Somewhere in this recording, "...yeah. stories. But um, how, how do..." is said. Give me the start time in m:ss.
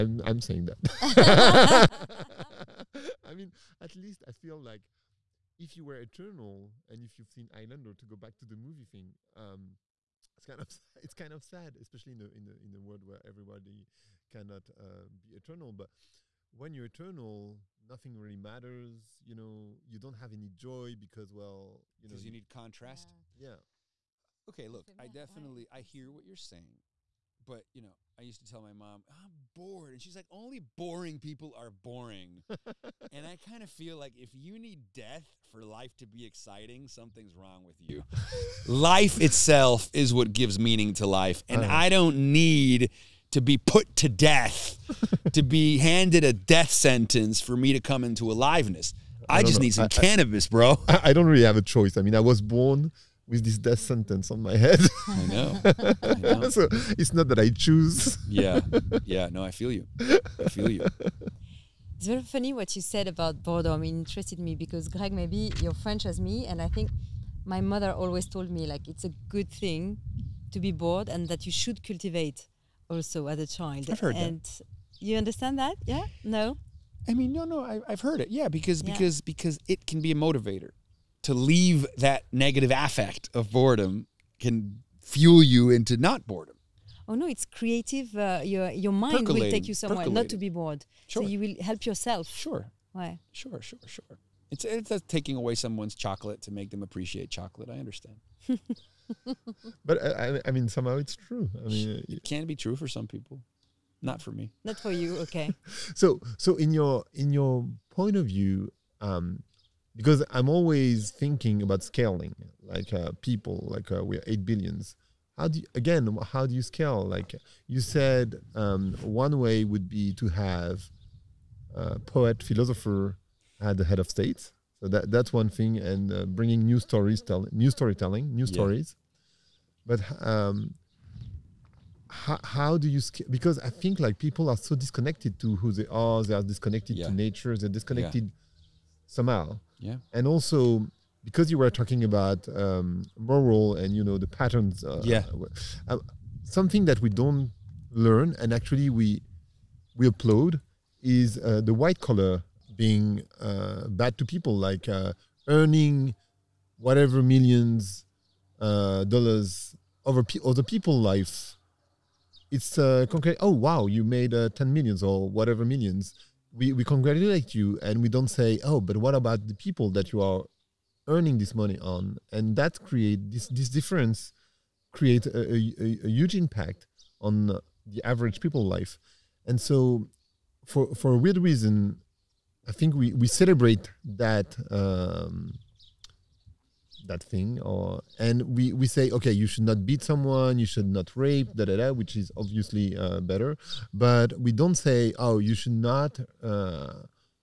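2:08.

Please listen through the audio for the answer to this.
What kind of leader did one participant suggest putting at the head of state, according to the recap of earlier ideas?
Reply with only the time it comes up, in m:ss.
2:01.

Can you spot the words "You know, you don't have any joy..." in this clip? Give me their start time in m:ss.
0:19.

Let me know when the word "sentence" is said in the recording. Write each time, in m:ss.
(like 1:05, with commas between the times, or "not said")
0:46, 0:53.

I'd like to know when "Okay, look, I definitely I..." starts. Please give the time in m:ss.
0:24.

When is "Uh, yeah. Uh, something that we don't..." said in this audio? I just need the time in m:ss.
2:24.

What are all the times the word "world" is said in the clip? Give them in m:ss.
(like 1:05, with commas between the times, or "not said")
0:12.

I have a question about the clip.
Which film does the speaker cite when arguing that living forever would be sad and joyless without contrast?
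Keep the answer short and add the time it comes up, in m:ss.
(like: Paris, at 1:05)
Highlander, at 0:07.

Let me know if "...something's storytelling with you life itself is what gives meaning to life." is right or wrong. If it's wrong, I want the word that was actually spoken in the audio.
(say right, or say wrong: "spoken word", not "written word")
wrong: "wrong", not "storytelling".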